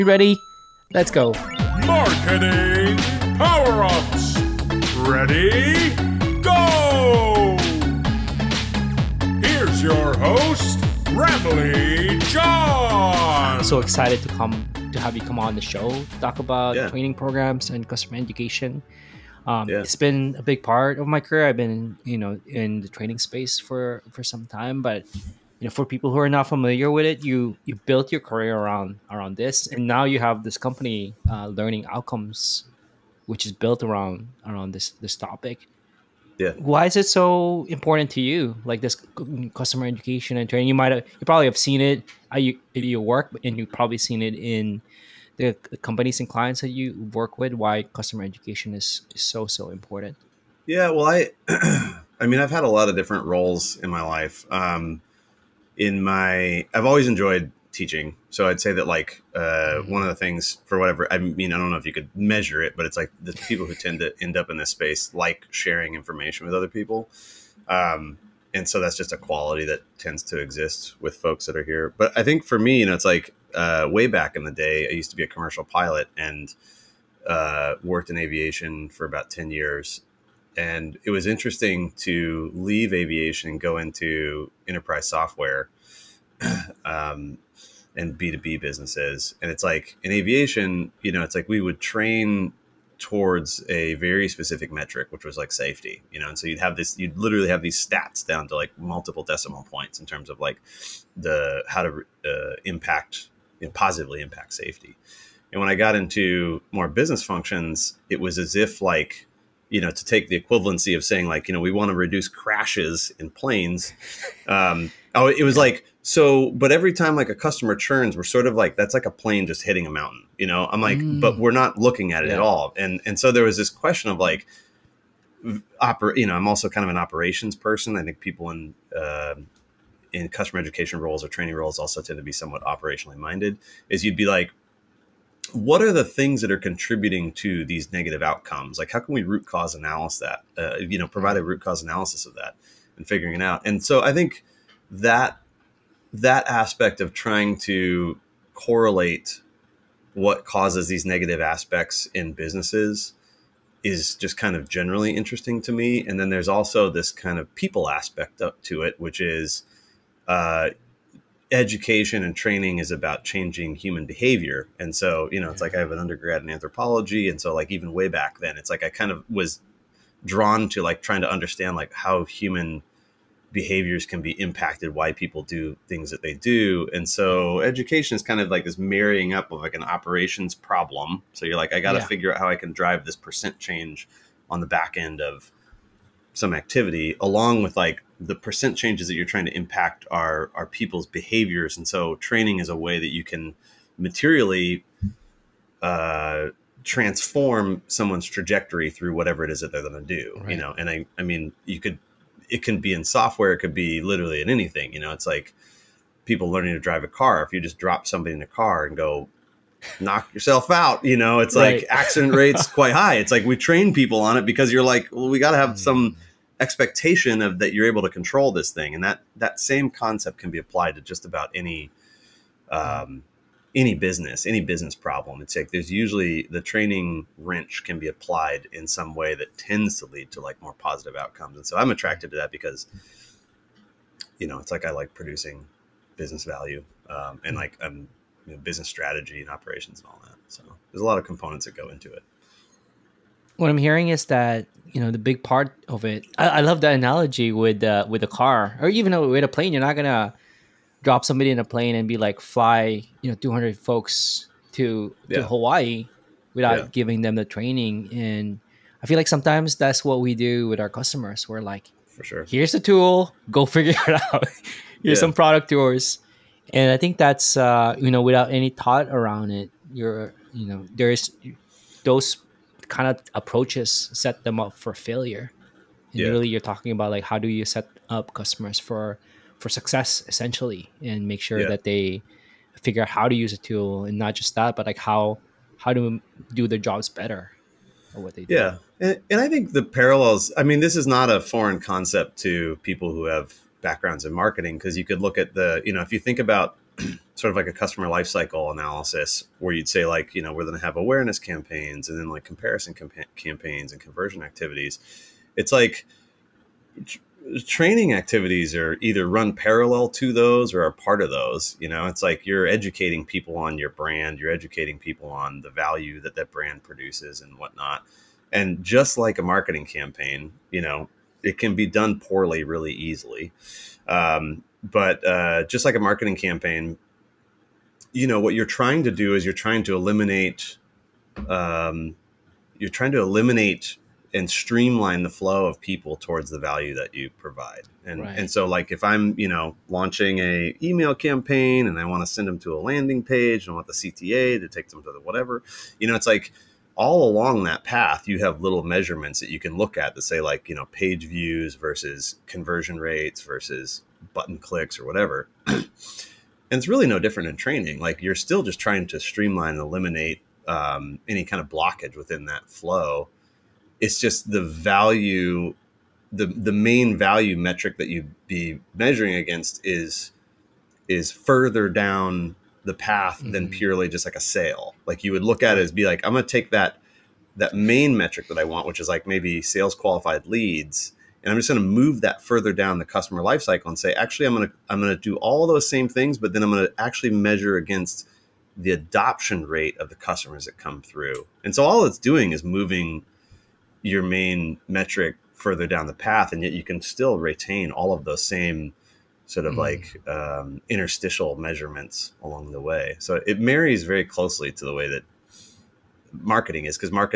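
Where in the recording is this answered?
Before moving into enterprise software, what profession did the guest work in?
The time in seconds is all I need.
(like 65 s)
75 s.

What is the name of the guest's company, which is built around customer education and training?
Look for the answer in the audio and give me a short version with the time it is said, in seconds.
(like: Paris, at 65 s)
Learning Outcomes, at 31 s.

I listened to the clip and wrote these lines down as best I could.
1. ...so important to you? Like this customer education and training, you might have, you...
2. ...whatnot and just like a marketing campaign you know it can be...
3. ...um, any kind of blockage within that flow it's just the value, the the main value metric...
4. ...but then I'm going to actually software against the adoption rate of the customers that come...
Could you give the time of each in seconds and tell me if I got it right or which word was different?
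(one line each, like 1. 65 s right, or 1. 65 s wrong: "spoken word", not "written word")
1. 37 s right
2. 317 s right
3. 360 s right
4. 386 s wrong: "measure", not "software".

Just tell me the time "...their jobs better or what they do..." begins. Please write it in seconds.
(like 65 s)
286 s.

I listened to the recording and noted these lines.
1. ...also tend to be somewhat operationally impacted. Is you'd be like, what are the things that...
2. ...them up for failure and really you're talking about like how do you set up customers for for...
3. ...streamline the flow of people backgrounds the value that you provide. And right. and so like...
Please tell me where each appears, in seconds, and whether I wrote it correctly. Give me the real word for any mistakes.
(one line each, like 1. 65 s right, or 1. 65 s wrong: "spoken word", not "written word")
1. 131 s wrong: "minded", not "impacted"
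2. 274 s right
3. 334 s wrong: "towards", not "backgrounds".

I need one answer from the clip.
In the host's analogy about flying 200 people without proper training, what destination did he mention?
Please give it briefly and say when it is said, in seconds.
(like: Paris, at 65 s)
Hawaii, at 255 s.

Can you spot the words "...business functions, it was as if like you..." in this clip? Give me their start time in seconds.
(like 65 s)
106 s.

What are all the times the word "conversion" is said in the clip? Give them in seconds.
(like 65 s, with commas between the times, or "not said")
304 s, 352 s.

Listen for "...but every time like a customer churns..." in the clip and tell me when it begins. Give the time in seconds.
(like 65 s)
116 s.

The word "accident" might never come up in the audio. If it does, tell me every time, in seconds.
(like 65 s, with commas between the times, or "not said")
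211 s.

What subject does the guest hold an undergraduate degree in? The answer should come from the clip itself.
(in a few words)
Anthropology.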